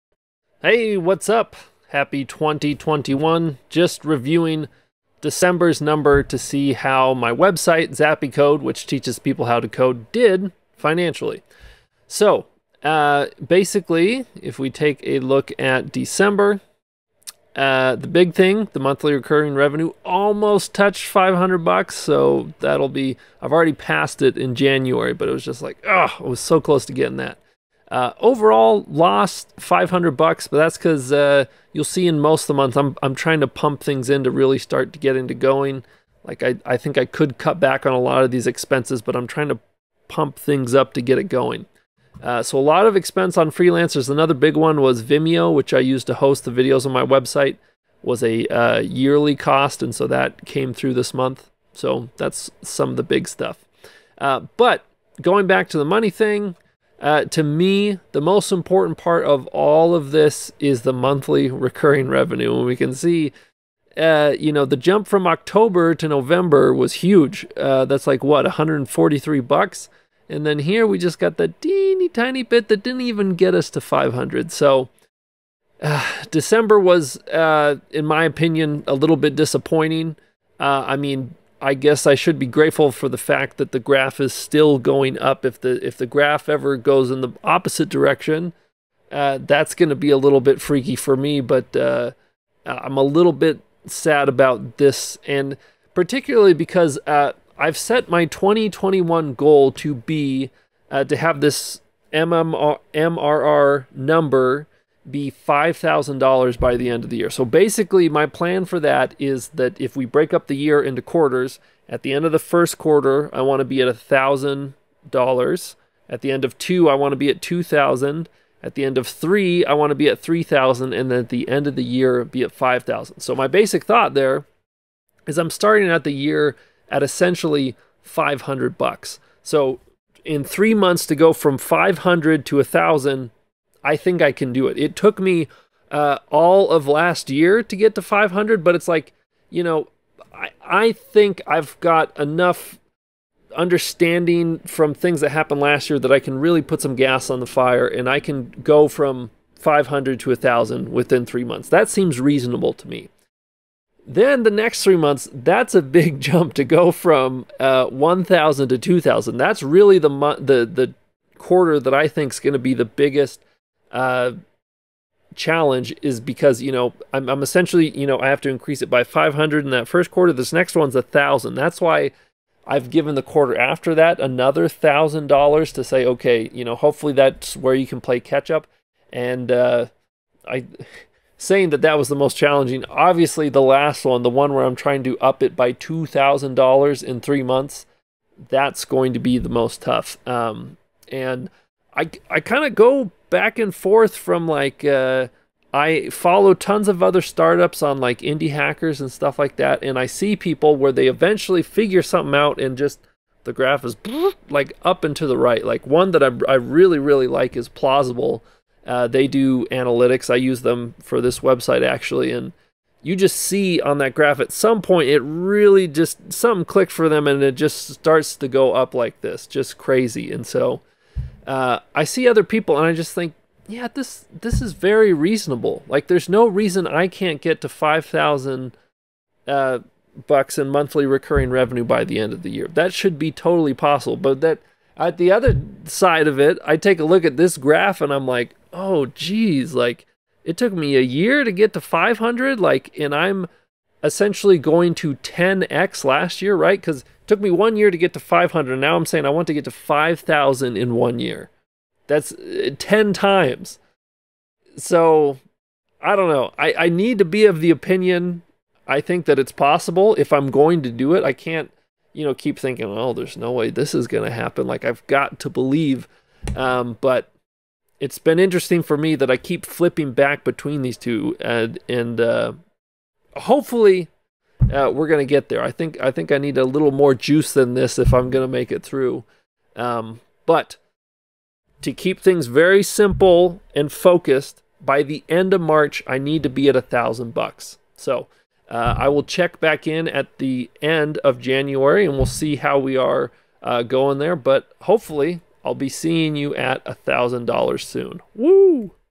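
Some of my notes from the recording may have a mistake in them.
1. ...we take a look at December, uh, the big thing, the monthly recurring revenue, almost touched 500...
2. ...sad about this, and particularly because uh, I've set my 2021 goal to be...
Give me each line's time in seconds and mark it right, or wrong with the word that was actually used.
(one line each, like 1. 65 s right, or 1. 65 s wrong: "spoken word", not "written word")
1. 14 s right
2. 93 s right.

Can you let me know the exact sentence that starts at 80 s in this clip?
Uh, I mean, I guess I should be grateful for the fact that the graph is still going up.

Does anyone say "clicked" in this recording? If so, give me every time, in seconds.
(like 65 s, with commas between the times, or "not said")
216 s.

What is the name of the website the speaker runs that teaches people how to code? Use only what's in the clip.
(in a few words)
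Zappy Code.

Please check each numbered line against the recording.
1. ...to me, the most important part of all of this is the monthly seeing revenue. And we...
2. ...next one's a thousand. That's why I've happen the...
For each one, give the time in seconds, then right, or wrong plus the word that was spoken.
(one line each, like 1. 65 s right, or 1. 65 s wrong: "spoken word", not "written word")
1. 57 s wrong: "recurring", not "seeing"
2. 170 s wrong: "given", not "happen".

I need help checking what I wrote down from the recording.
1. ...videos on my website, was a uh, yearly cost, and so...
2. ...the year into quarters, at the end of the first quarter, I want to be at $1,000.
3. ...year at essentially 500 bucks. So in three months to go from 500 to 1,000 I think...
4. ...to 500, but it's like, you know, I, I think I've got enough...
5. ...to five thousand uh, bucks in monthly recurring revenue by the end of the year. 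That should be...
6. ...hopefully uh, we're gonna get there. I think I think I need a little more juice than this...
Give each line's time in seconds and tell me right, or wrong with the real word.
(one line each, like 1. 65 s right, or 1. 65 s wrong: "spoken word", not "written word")
1. 46 s right
2. 110 s right
3. 126 s right
4. 137 s right
5. 227 s right
6. 273 s right.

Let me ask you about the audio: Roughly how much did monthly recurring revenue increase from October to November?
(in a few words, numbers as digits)
$143.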